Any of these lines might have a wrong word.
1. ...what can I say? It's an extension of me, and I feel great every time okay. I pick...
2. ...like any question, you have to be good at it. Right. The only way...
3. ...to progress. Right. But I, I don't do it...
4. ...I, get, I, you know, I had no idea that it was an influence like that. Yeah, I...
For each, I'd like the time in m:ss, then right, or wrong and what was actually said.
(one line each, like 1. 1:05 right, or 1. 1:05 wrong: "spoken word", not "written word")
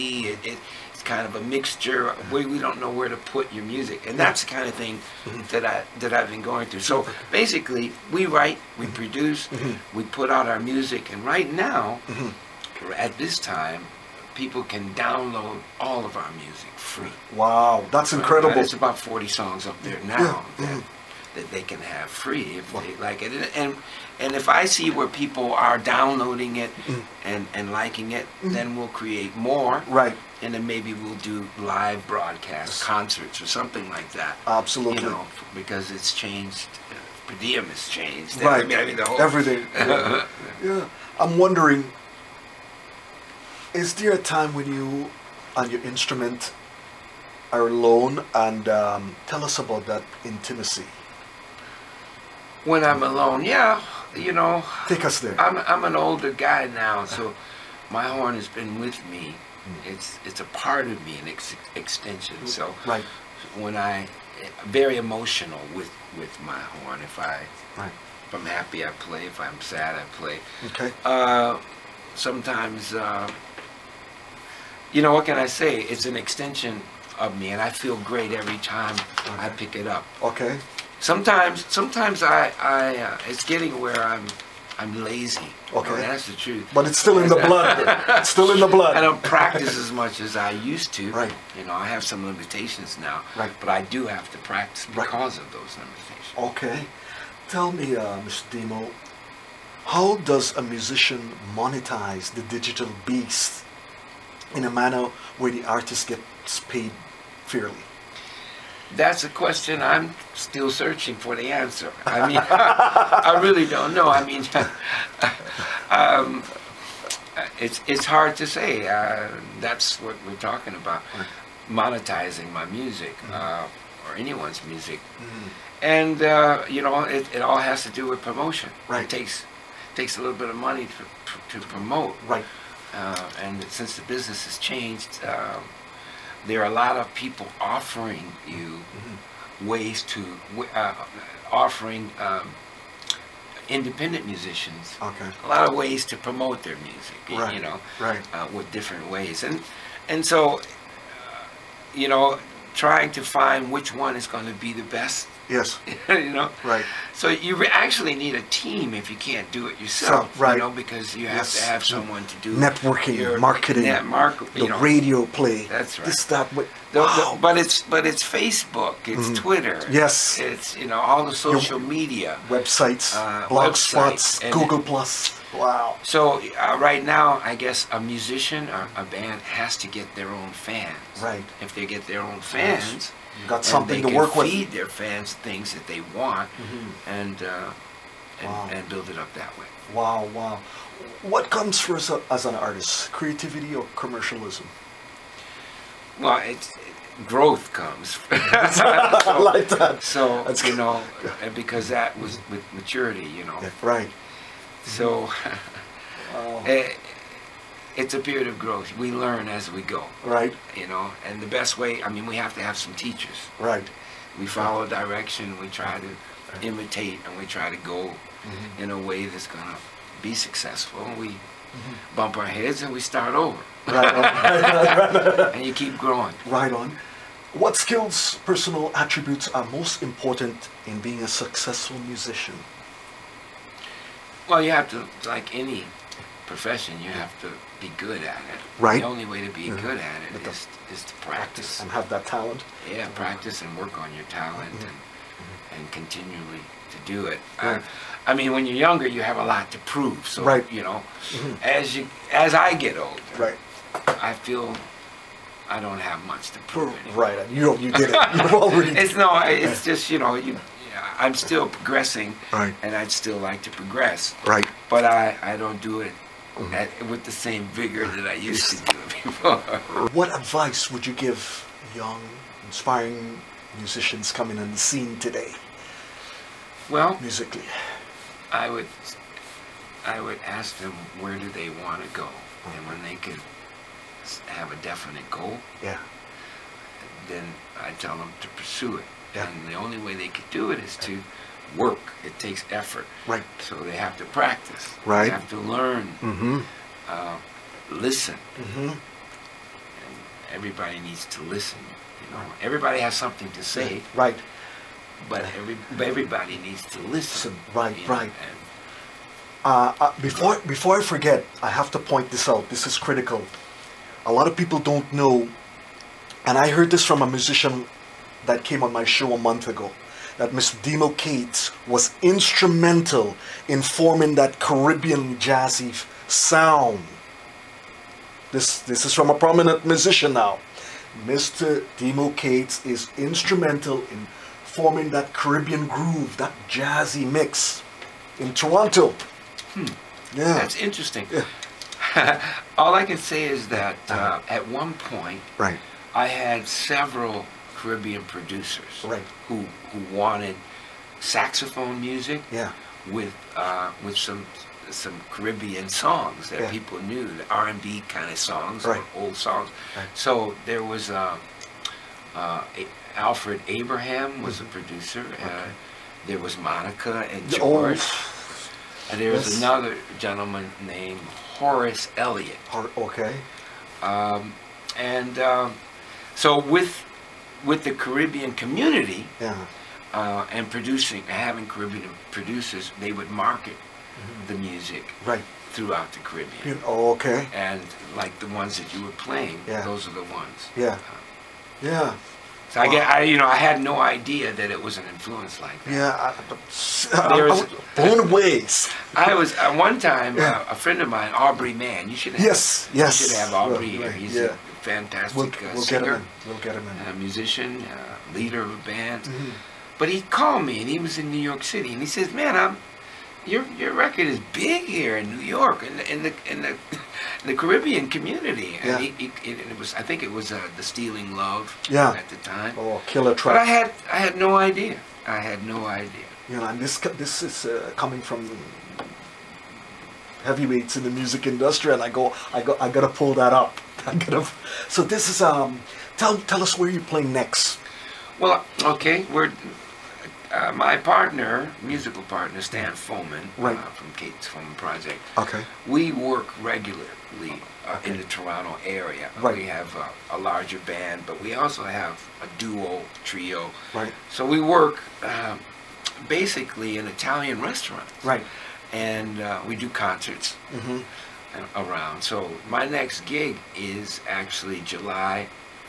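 1. 1:15 right
2. 3:55 wrong: "profession", not "question"
3. 4:23 right
4. 6:32 right.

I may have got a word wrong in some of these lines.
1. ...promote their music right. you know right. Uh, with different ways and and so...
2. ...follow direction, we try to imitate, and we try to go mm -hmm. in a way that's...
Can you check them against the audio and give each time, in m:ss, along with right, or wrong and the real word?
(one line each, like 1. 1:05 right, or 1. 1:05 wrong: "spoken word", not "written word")
1. 2:26 right
2. 3:34 right.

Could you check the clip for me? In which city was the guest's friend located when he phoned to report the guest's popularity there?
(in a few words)
New York City.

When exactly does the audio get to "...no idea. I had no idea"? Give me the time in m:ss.
7:04.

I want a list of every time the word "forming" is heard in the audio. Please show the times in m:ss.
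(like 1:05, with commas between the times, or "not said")
5:23, 5:34.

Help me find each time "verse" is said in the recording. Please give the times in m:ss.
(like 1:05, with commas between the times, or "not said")
not said.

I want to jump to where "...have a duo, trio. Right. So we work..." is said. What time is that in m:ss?
7:31.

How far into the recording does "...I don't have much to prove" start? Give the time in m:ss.
4:15.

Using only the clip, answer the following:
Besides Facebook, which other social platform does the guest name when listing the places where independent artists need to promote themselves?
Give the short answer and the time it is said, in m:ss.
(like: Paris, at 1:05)
Twitter, at 2:49.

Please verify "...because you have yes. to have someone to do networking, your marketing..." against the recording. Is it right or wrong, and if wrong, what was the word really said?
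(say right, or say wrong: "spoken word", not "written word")
right.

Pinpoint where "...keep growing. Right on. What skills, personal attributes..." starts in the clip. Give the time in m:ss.
3:45.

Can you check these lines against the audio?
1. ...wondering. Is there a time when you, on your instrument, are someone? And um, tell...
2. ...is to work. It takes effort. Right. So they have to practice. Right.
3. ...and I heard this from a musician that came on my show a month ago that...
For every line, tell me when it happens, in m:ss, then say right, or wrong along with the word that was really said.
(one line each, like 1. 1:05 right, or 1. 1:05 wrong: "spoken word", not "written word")
1. 0:41 wrong: "alone", not "someone"
2. 4:50 right
3. 5:16 right.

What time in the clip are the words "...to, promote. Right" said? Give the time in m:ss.
2:11.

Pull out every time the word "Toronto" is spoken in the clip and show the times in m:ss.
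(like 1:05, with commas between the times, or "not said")
5:38, 7:28.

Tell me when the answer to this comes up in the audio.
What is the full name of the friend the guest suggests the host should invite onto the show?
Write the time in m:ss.
6:41.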